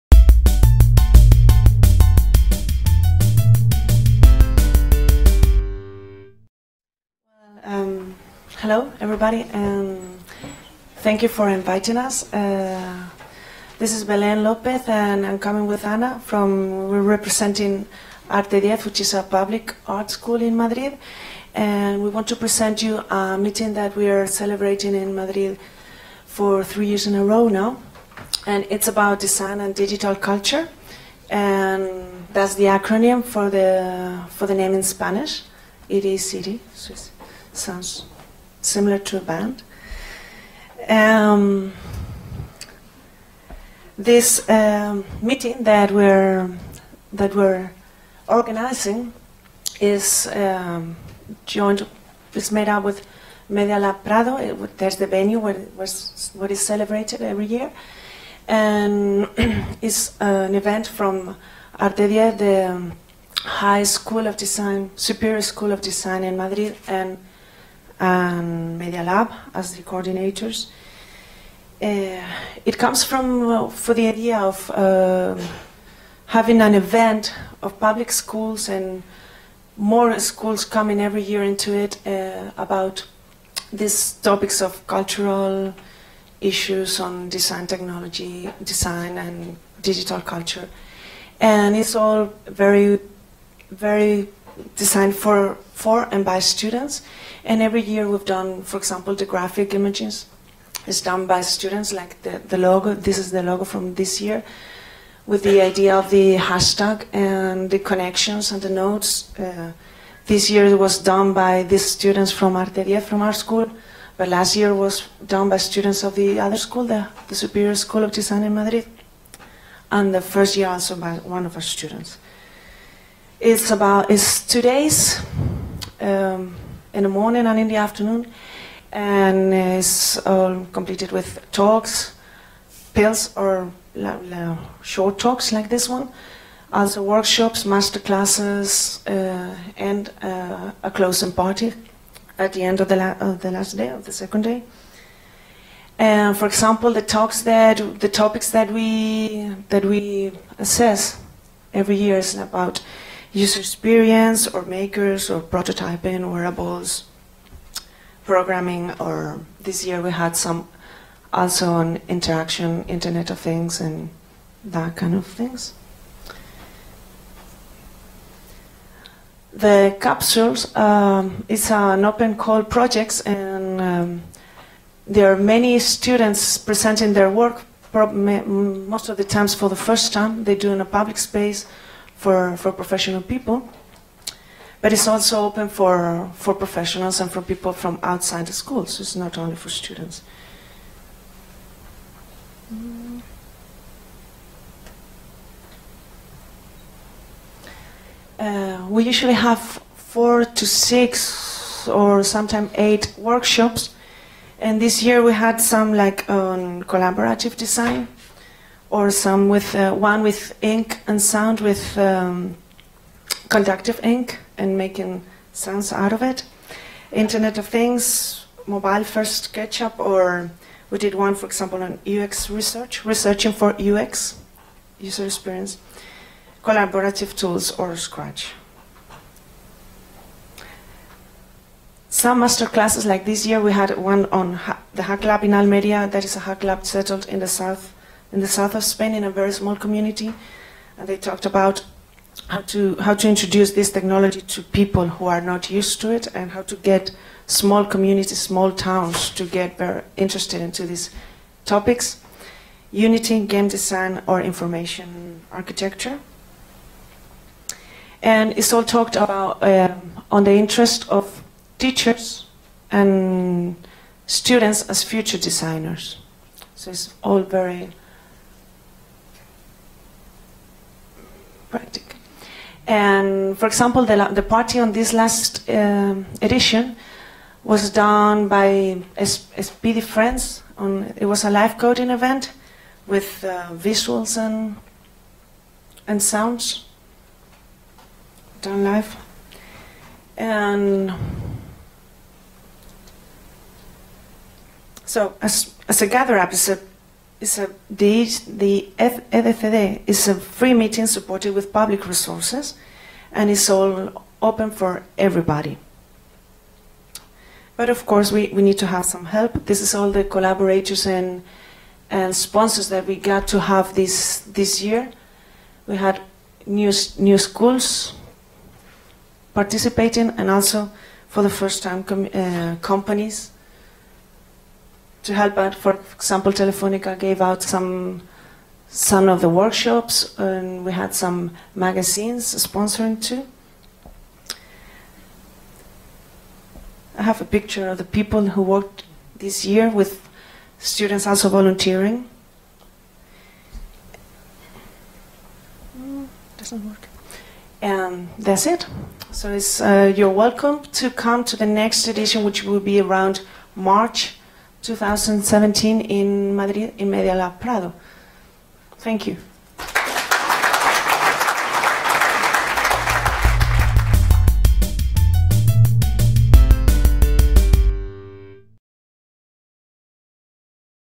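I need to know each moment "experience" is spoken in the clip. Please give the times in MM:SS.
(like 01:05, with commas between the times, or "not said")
02:33, 03:45.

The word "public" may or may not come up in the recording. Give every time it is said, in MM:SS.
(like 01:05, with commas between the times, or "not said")
00:19, 01:17, 03:00, 05:01.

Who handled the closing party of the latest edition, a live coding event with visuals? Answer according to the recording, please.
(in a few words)
Speedy Friends.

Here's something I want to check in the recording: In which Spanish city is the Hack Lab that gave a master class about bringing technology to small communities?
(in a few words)
Almeria.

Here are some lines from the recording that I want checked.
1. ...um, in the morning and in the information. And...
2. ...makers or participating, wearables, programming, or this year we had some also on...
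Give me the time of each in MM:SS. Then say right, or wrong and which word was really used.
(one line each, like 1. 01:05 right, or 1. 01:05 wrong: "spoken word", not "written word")
1. 02:06 wrong: "afternoon", not "information"
2. 02:34 wrong: "prototyping", not "participating".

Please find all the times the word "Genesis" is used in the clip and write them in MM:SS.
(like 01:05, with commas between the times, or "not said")
not said.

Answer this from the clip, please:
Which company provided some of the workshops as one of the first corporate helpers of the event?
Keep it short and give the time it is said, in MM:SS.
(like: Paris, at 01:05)
Telefonica, at 05:26.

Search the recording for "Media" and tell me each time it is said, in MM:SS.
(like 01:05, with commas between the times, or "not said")
00:53, 01:08, 05:57.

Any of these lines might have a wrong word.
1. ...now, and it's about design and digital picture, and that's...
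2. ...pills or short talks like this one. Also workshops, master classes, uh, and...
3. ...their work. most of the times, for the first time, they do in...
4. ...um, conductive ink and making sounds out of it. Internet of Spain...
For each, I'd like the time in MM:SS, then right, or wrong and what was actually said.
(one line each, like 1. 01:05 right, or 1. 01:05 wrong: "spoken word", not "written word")
1. 00:27 wrong: "culture", not "picture"
2. 02:12 right
3. 02:57 right
4. 03:31 wrong: "Things", not "Spain".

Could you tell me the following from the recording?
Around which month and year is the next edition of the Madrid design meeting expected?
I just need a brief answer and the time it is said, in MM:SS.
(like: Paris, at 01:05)
March 2017, at 05:53.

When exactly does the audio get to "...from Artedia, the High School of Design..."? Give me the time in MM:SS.
01:00.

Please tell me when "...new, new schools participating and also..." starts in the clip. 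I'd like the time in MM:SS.
05:16.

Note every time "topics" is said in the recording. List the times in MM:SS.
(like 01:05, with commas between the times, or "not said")
01:24, 02:28, 04:11.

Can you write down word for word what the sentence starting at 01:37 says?
And every year we've done, for example, the graphic images.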